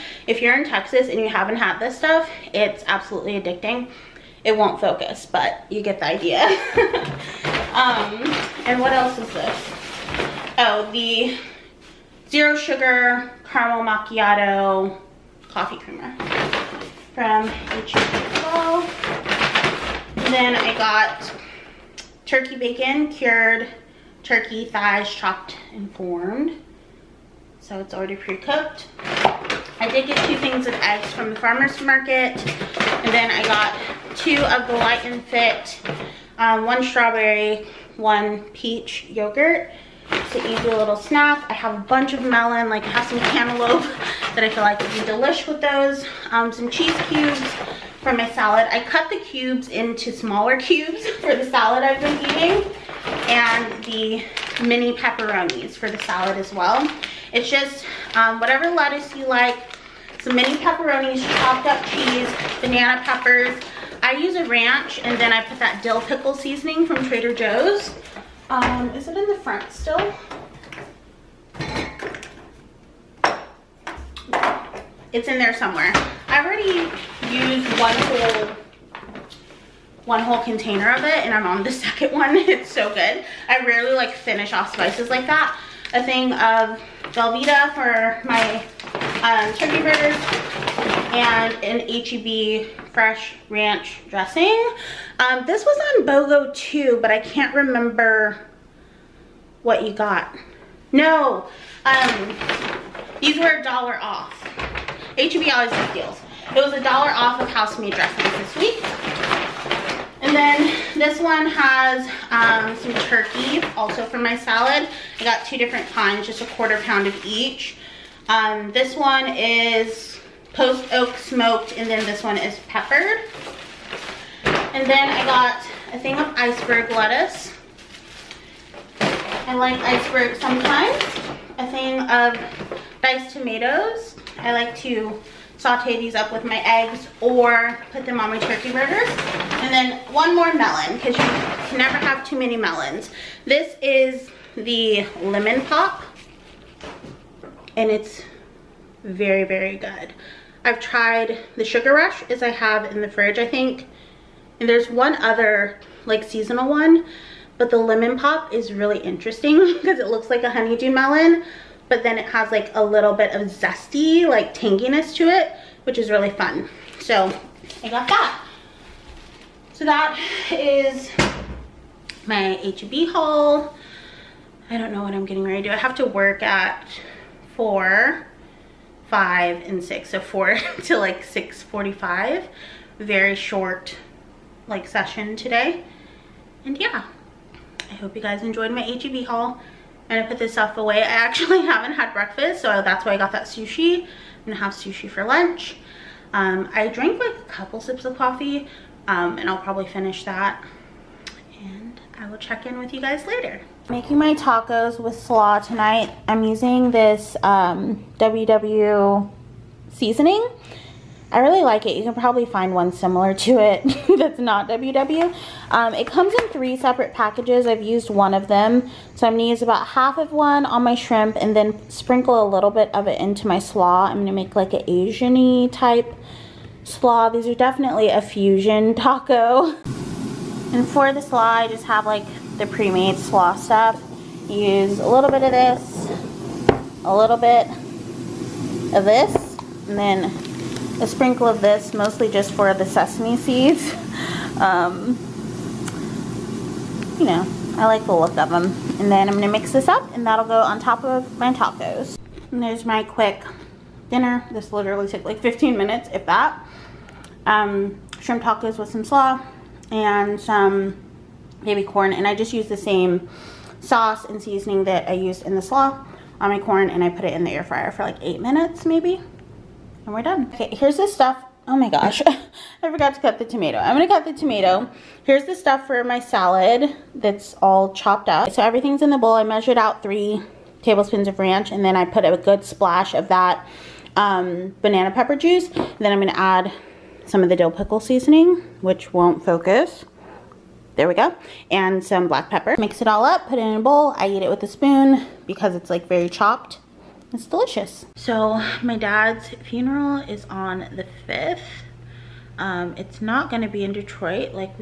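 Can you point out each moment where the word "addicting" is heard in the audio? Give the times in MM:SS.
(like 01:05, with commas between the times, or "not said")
00:03.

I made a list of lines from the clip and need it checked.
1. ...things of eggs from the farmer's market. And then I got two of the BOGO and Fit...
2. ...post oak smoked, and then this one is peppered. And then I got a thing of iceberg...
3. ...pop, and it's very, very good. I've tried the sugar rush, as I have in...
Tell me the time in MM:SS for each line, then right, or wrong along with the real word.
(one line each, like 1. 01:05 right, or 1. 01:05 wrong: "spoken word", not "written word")
1. 00:30 wrong: "Light", not "BOGO"
2. 02:00 right
3. 02:25 right.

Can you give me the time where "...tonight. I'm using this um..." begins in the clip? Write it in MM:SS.
03:25.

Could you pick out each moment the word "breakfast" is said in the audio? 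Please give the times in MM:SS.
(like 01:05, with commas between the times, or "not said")
03:12.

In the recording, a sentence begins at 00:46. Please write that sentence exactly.
Um, some cheese cubes for my salad.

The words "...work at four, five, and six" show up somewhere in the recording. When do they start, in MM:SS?
02:56.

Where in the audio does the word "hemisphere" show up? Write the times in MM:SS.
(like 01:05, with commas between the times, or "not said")
not said.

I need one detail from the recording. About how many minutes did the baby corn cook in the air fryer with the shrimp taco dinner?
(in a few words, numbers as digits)
8.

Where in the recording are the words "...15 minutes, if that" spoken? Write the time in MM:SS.
04:15.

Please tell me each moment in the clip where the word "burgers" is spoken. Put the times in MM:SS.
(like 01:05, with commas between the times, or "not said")
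01:29, 02:18.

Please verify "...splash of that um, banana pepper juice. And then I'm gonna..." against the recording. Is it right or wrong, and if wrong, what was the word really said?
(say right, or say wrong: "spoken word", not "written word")
right.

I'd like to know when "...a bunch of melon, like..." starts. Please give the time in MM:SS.
00:41.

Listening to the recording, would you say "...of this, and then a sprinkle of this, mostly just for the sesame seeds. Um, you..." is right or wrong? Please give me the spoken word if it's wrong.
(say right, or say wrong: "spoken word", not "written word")
right.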